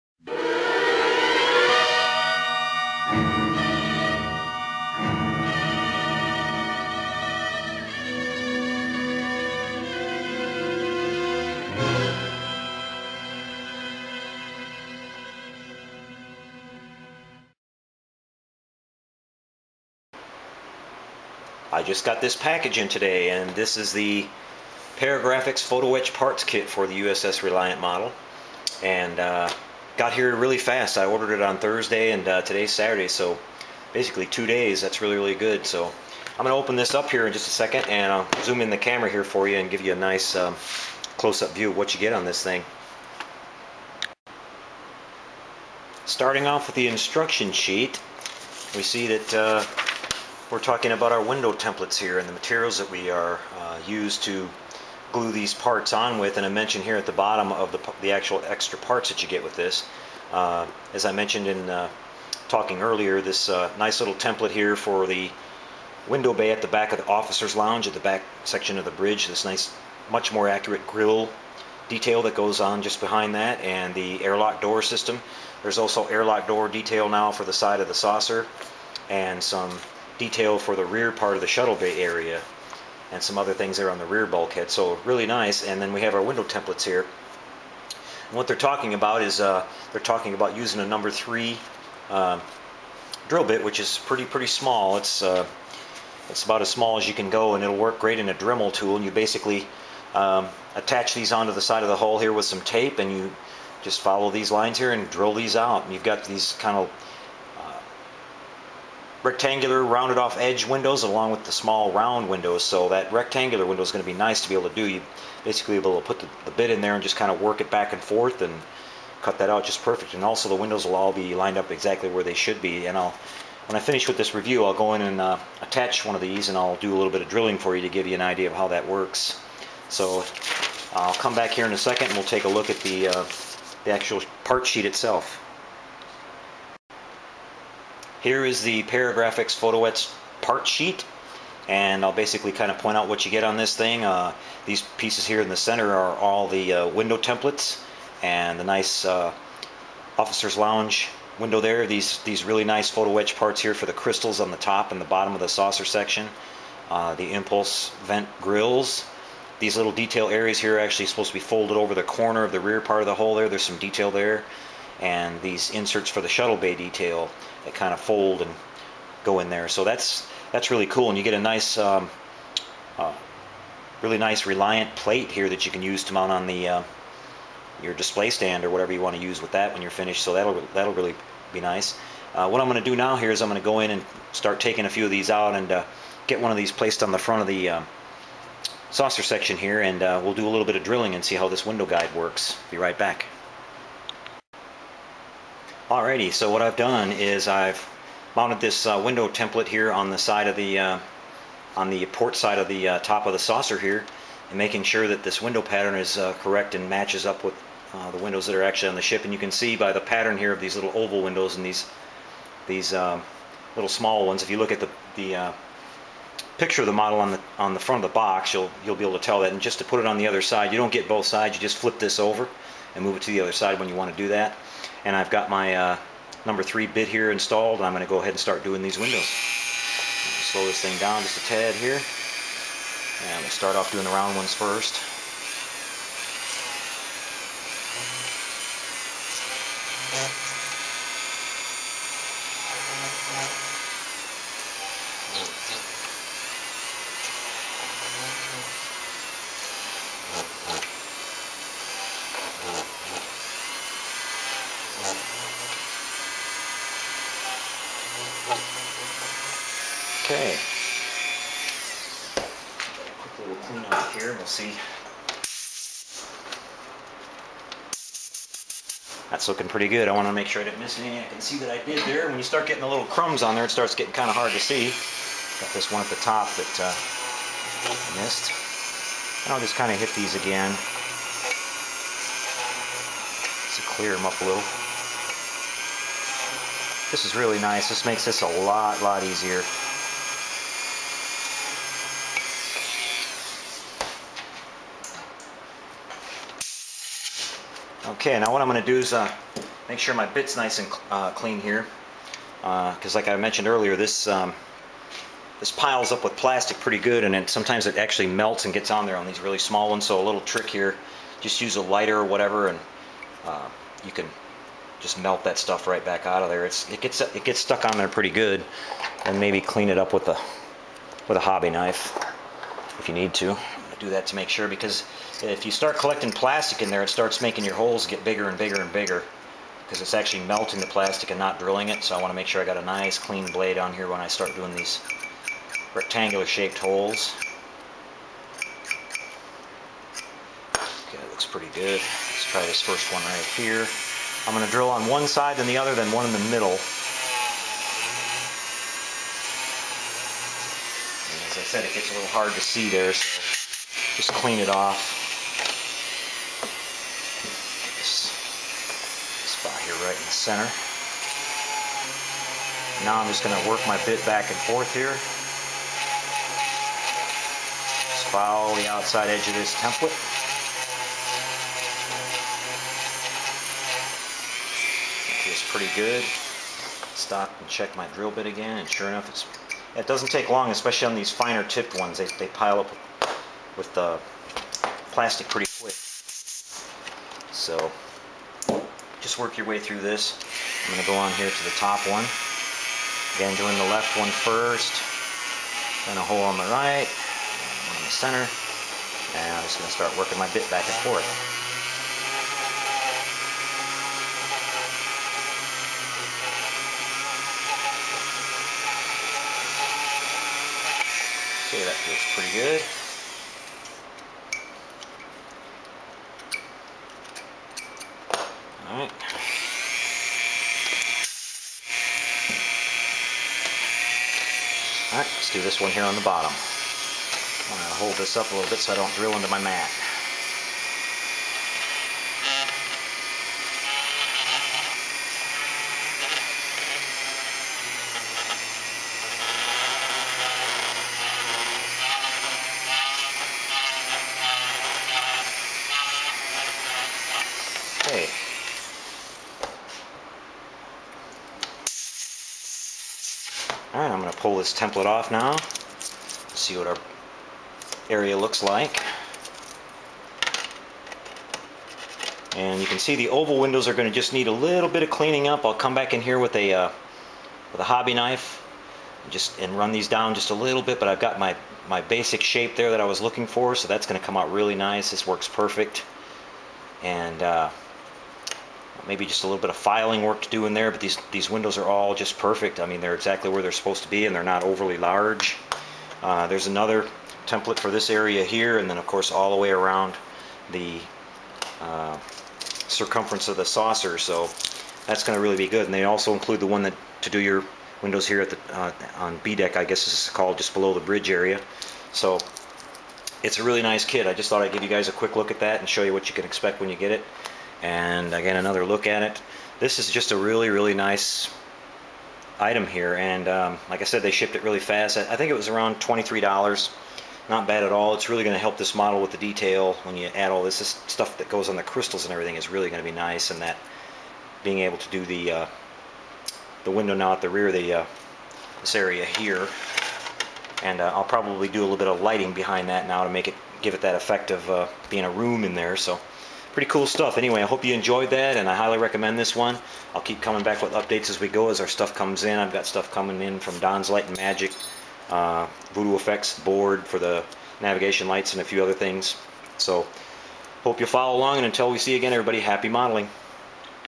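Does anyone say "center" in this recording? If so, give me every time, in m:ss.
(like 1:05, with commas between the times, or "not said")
2:25, 6:00, 6:38.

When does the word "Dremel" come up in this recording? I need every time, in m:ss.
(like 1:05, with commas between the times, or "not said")
1:38.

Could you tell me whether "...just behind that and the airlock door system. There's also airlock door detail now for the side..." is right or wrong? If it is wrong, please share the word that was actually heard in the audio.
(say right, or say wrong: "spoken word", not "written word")
right.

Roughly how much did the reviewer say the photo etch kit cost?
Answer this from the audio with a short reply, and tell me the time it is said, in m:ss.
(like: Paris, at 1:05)
$23, at 8:35.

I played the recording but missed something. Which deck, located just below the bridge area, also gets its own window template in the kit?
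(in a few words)
B deck.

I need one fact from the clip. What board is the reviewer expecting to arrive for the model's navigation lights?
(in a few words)
Voodoo Effects board.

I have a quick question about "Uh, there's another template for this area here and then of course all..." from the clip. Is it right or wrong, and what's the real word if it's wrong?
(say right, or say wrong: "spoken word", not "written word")
right.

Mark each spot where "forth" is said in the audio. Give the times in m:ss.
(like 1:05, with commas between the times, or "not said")
1:58, 6:04, 6:41.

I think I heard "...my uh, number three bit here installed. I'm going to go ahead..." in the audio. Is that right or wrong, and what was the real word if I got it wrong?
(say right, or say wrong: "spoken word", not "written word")
right.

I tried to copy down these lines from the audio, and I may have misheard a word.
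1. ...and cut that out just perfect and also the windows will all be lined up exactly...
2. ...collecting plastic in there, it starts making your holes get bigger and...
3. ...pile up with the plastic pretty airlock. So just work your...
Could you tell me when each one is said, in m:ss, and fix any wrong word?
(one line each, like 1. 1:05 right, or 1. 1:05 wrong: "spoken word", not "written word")
1. 1:58 right
2. 5:25 right
3. 6:22 wrong: "quick", not "airlock".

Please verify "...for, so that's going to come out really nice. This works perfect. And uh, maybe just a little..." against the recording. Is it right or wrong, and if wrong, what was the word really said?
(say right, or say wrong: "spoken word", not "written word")
right.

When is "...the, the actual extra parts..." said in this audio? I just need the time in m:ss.
0:57.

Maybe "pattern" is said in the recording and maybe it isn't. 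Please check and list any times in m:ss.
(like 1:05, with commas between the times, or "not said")
3:25, 3:29.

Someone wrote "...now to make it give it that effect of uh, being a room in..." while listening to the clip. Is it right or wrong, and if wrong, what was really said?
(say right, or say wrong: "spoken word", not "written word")
right.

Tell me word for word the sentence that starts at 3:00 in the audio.
So that'll that'll really be nice.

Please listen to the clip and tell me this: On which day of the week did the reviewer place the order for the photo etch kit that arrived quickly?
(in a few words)
Thursday.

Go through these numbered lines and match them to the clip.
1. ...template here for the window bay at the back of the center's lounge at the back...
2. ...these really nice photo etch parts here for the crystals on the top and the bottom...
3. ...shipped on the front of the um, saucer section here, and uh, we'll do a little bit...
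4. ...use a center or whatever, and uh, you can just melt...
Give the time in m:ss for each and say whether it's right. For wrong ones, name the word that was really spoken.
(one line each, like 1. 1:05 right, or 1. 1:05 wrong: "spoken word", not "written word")
1. 1:04 wrong: "officer", not "center"
2. 2:32 right
3. 3:06 wrong: "placed", not "shipped"
4. 5:11 wrong: "lighter", not "center".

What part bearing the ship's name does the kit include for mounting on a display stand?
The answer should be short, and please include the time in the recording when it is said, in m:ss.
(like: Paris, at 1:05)
Reliant plate, at 2:54.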